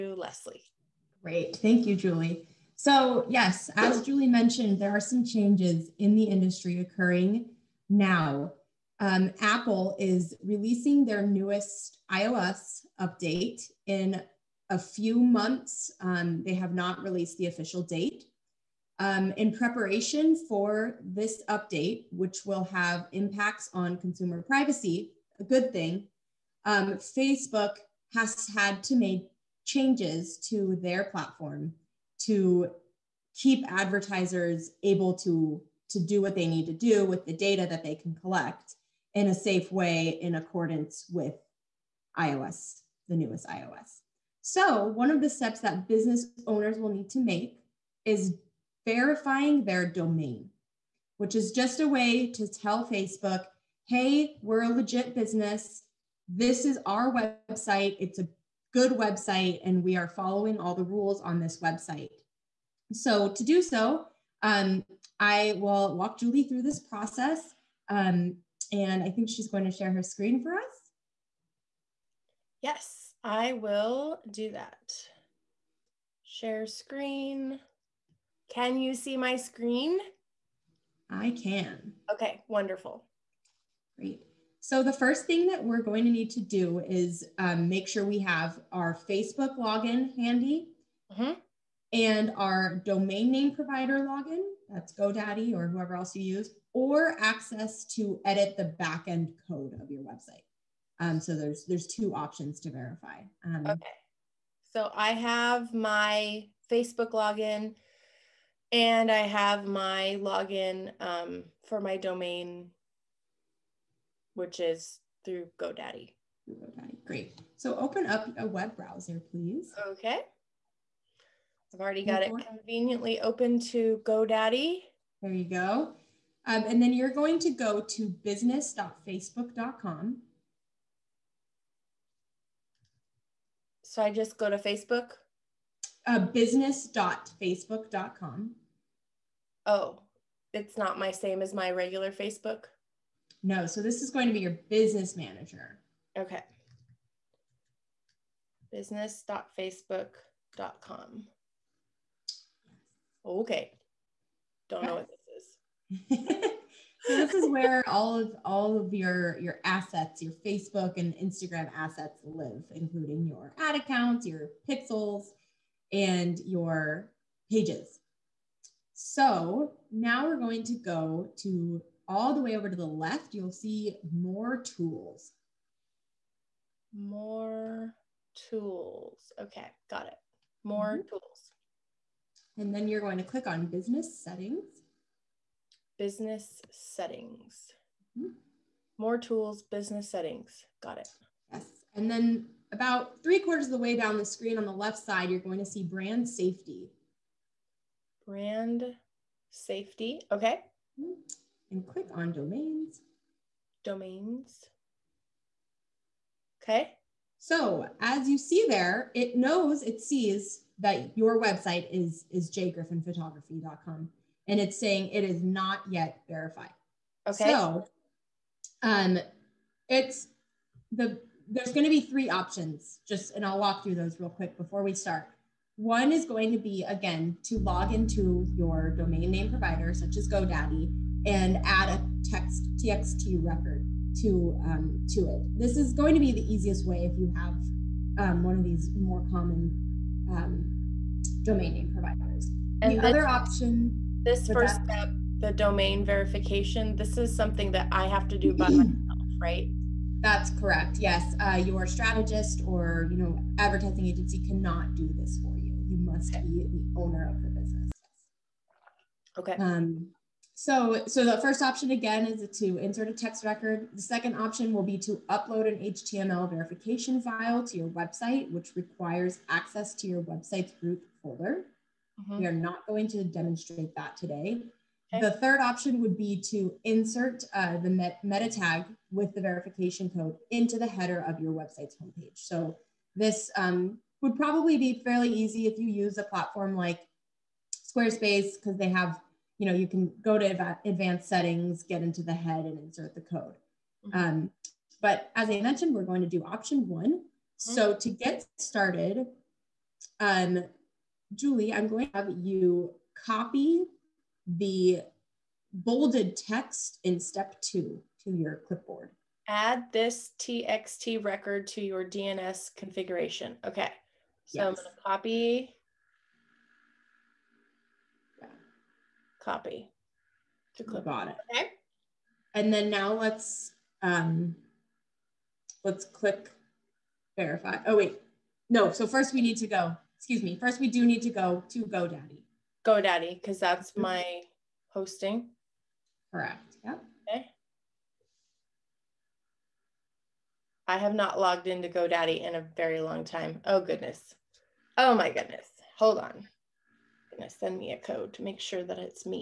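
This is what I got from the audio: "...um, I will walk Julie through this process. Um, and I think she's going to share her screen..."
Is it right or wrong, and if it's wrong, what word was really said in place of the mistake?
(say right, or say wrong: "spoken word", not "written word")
right.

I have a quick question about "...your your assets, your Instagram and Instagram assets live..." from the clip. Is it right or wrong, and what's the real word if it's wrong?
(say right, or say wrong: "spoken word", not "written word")
wrong: "Facebook", not "Instagram".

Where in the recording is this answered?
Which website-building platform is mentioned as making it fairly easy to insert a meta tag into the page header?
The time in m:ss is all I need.
4:47.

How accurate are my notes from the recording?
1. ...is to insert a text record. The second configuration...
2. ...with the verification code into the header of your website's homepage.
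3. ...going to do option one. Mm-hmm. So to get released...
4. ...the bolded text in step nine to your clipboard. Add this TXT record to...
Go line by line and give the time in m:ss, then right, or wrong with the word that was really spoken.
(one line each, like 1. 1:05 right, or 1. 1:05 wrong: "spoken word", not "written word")
1. 4:22 wrong: "option", not "configuration"
2. 4:39 right
3. 4:56 wrong: "started", not "released"
4. 5:04 wrong: "two", not "nine".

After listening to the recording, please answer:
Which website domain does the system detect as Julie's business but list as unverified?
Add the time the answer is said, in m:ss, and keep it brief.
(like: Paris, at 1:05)
jgriffinphotography.com, at 3:32.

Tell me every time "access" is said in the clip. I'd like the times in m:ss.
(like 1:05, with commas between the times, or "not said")
1:37, 4:29.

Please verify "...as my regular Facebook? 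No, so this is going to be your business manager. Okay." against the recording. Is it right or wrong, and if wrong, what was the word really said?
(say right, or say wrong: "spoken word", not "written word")
right.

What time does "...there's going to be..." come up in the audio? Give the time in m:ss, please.
3:41.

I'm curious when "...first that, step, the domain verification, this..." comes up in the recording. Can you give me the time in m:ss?
4:04.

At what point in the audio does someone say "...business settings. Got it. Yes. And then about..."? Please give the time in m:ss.
3:09.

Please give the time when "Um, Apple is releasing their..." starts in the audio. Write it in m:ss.
0:09.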